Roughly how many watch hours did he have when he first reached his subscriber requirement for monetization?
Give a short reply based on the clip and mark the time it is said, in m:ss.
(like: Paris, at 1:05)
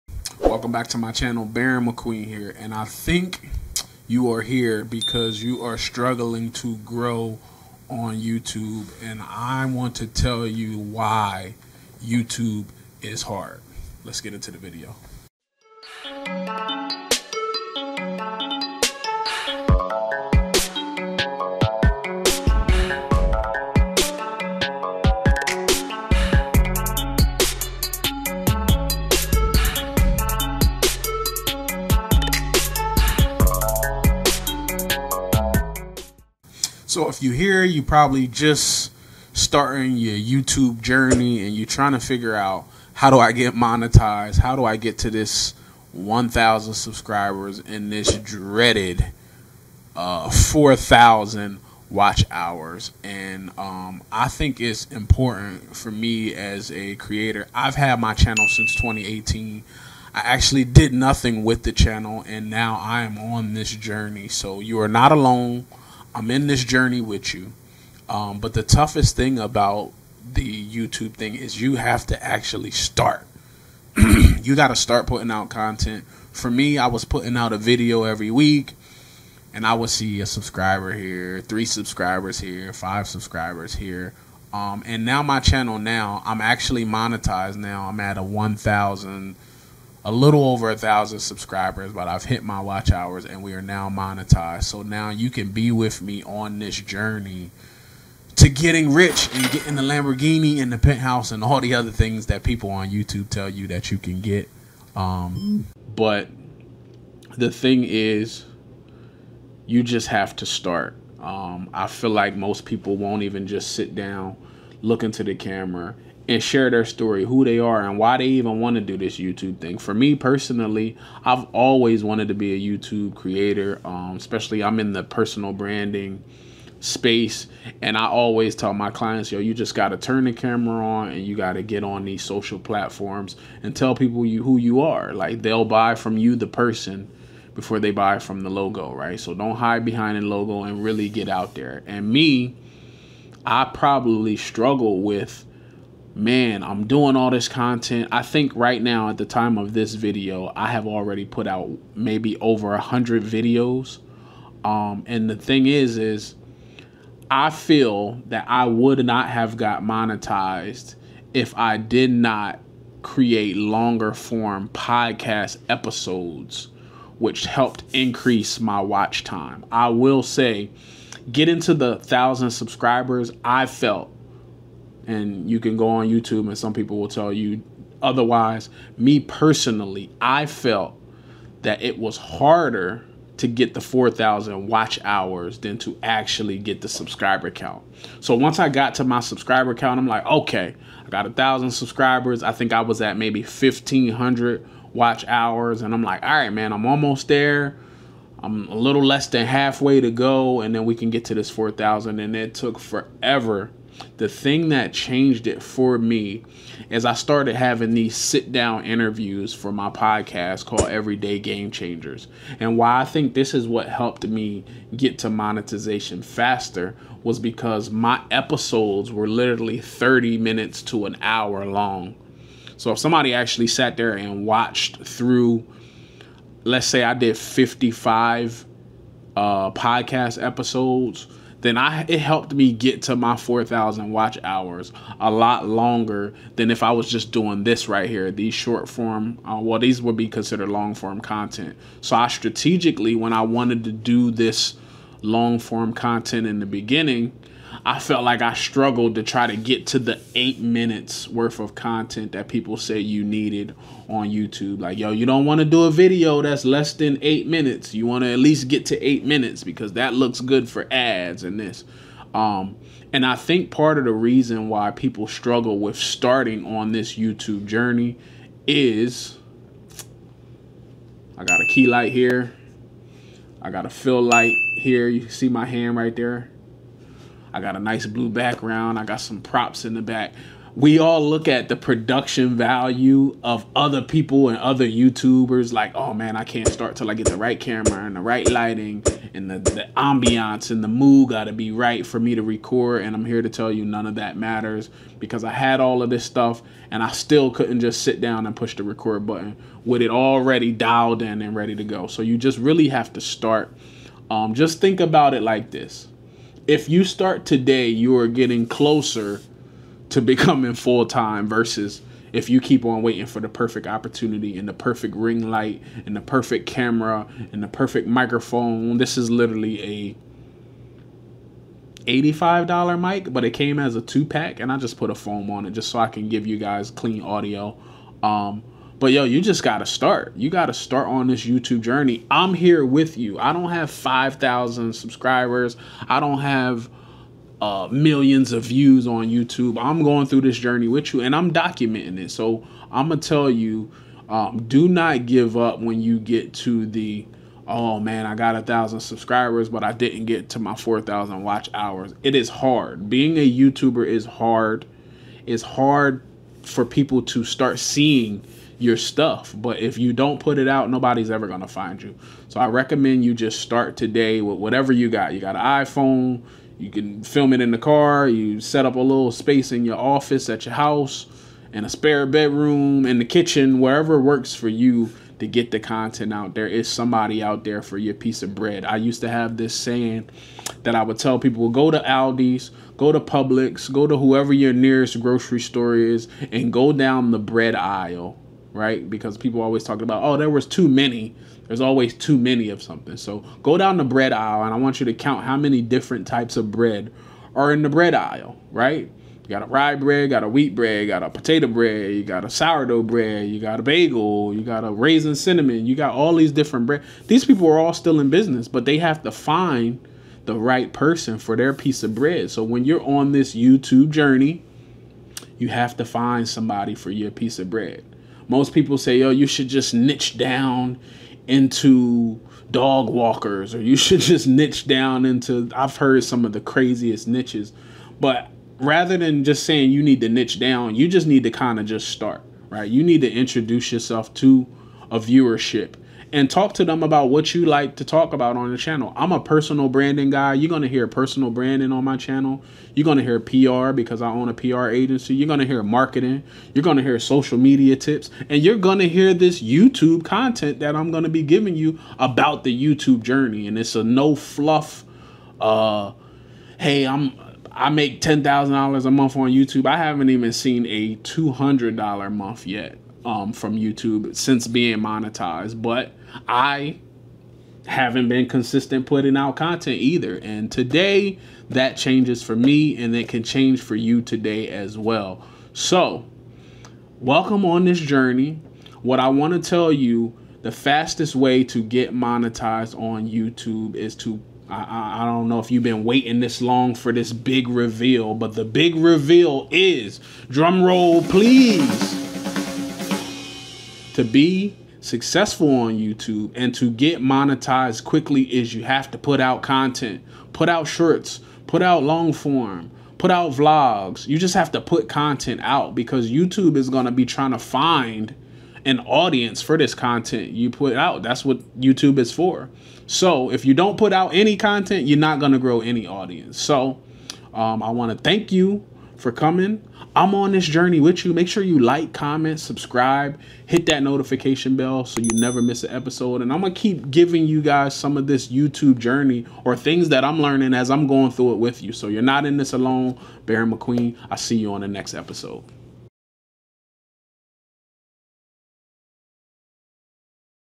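1,500, at 3:13.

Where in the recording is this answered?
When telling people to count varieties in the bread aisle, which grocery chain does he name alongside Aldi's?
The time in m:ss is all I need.
6:23.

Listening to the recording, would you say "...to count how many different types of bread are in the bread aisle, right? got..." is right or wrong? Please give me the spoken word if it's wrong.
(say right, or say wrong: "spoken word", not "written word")
right.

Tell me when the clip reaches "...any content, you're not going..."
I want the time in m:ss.
8:34.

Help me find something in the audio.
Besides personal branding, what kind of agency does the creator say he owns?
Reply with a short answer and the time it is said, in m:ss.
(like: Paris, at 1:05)
PR agency, at 7:24.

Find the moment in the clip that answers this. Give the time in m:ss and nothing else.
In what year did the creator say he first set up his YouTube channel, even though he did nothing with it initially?
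0:58.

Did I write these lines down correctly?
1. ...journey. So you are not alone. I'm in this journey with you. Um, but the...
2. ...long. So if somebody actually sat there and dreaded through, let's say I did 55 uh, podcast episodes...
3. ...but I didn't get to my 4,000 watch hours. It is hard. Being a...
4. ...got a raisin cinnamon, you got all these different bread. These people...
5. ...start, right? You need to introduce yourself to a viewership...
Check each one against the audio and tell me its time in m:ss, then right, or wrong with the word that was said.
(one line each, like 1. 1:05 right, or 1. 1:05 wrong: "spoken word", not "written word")
1. 1:03 right
2. 3:41 wrong: "watched", not "dreaded"
3. 5:49 right
4. 6:44 right
5. 7:12 right.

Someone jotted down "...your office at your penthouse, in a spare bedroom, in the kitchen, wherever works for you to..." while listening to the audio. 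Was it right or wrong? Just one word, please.
wrong.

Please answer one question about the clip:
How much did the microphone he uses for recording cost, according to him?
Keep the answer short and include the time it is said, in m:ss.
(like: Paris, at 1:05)
$85, at 5:22.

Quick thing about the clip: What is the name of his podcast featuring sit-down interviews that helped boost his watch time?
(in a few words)
Everyday Game Changers.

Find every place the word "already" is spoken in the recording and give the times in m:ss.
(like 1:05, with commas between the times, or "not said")
2:30, 5:00.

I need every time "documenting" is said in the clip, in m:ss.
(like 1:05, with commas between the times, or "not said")
5:41.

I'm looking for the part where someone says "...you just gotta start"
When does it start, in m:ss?
5:29.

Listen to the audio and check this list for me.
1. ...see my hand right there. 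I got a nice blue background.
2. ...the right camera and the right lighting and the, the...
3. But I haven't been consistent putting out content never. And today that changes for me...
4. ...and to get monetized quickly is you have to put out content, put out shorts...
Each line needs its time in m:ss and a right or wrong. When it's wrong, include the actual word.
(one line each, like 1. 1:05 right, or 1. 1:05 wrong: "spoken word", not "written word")
1. 4:35 right
2. 4:47 right
3. 7:45 wrong: "either", not "never"
4. 8:16 right.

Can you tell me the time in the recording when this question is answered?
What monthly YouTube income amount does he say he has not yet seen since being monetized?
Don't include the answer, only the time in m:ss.
7:41.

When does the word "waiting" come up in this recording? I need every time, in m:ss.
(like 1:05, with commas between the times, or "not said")
5:13, 8:06.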